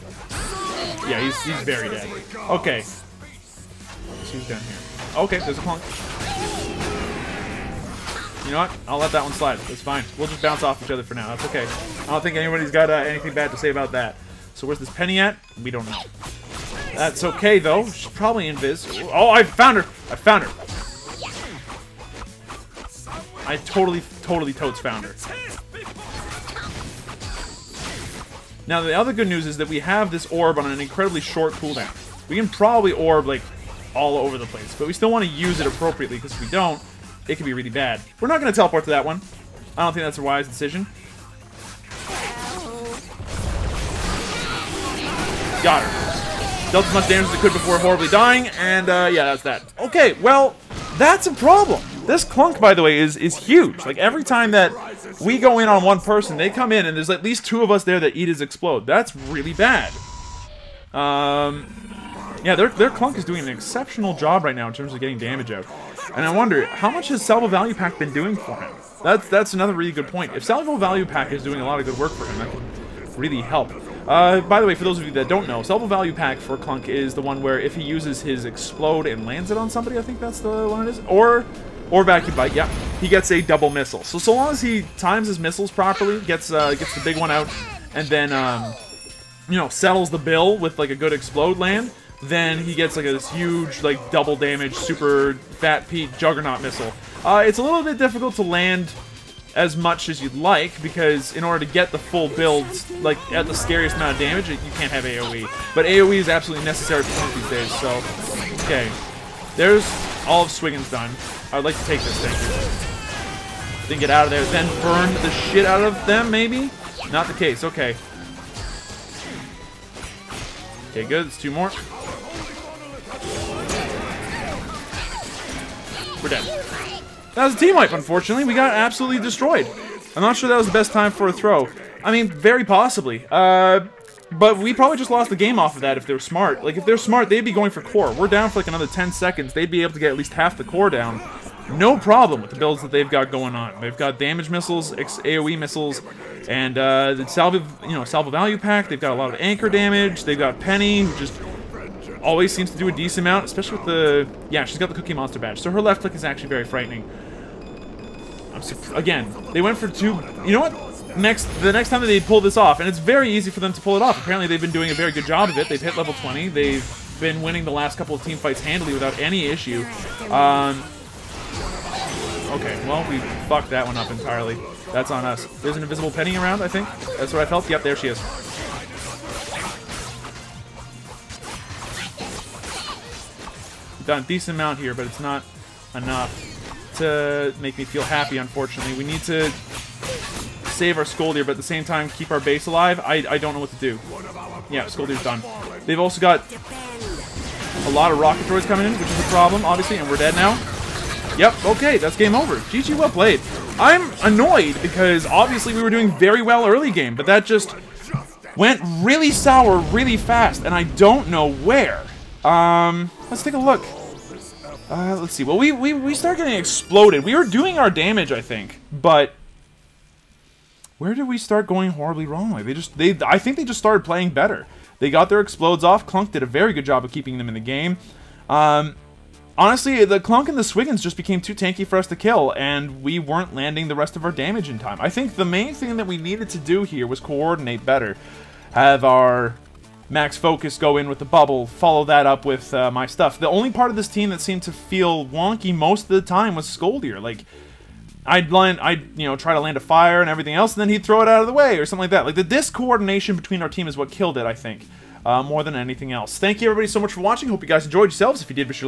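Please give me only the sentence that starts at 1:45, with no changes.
But AoE is absolutely necessary for these days, so...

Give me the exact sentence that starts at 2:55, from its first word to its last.
There's an invisible penny around, I think.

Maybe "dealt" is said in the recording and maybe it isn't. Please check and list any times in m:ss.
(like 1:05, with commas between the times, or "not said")
0:46.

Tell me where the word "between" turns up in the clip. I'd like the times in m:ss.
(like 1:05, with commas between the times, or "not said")
4:13.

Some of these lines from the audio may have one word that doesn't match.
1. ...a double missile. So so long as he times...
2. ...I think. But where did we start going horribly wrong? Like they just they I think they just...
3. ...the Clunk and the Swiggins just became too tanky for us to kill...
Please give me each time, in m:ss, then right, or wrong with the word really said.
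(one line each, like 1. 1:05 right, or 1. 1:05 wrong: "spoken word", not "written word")
1. 1:23 right
2. 3:38 right
3. 3:50 right.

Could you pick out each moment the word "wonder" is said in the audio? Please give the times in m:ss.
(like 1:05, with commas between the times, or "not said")
1:06.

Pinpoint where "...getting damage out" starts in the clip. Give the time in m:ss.
1:04.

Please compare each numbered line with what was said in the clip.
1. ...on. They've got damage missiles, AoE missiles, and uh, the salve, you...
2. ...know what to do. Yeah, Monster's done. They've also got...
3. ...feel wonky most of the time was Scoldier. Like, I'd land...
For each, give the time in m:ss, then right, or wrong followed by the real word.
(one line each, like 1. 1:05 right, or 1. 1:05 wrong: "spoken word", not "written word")
1. 2:23 right
2. 3:13 wrong: "Scoldier", not "Monster"
3. 4:04 right.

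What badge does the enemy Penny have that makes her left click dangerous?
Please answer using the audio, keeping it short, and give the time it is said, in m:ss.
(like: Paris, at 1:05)
Cookie Monster, at 2:34.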